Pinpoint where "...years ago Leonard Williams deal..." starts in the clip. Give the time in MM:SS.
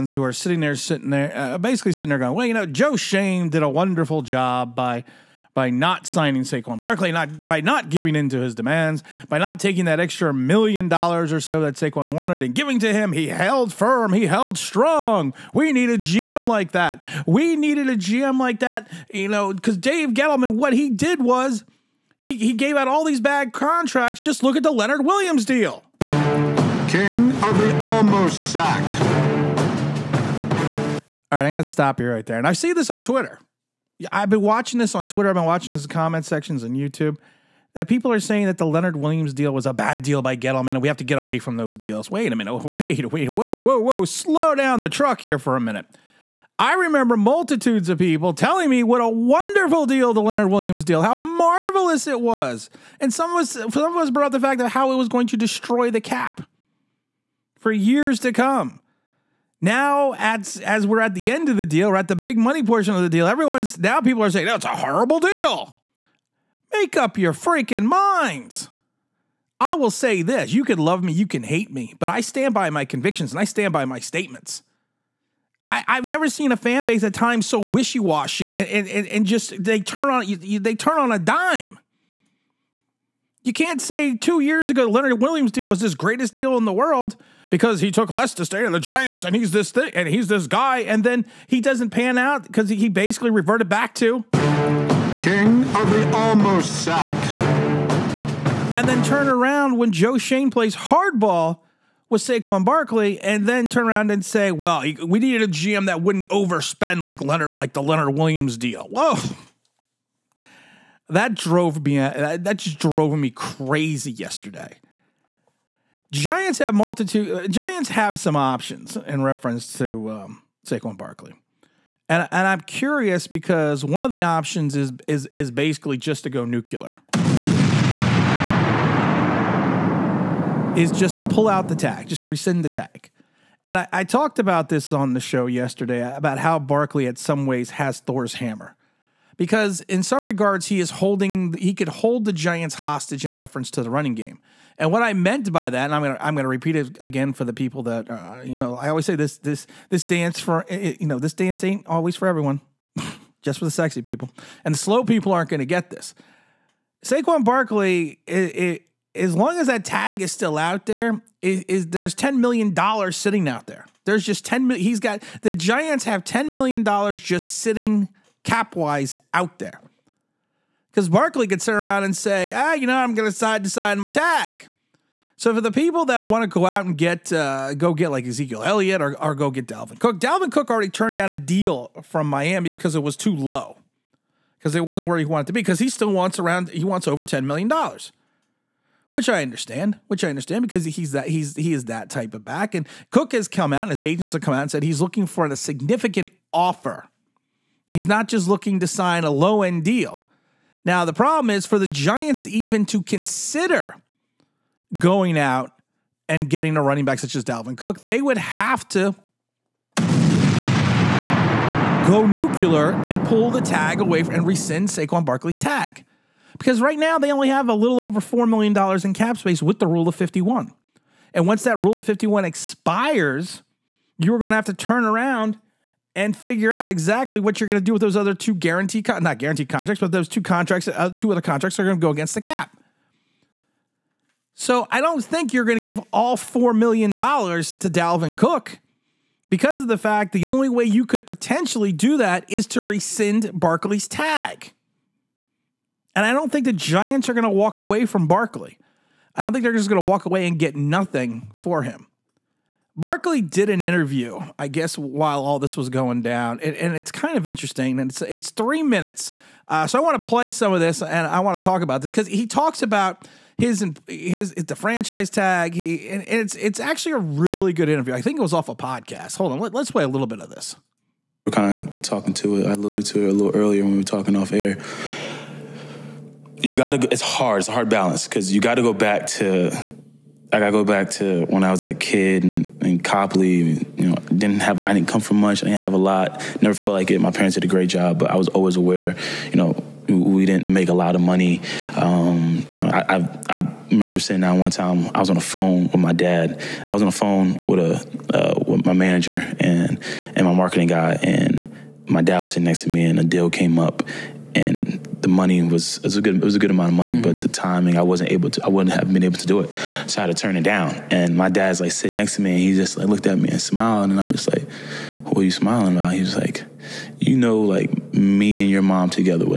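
01:24.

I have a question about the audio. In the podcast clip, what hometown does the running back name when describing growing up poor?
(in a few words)
Coplay.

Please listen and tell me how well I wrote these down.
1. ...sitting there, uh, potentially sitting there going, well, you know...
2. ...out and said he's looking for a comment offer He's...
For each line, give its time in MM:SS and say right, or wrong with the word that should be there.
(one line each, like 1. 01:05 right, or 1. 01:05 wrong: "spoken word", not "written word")
1. 00:00 wrong: "basically", not "potentially"
2. 03:14 wrong: "significant", not "comment".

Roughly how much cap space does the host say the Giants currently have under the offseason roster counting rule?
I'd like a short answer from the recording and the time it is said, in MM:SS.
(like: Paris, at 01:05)
$4 million, at 03:37.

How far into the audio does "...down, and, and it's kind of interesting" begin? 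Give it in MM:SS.
04:16.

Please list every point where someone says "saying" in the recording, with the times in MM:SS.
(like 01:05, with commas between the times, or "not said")
00:38, 01:04.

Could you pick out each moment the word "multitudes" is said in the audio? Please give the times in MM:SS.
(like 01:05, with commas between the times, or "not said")
00:47, 01:56.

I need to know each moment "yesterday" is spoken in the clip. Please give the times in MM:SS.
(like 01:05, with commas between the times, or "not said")
01:54, 02:15.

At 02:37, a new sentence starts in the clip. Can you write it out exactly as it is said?
Saquon Barkley, it, it, as long as that tag is still out there, is, there's ten million dollars sitting out there.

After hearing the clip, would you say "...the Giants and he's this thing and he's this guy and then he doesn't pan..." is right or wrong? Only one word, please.
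right.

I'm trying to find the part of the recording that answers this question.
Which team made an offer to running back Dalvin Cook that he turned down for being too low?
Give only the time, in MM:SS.
03:02.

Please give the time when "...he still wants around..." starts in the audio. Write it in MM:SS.
03:05.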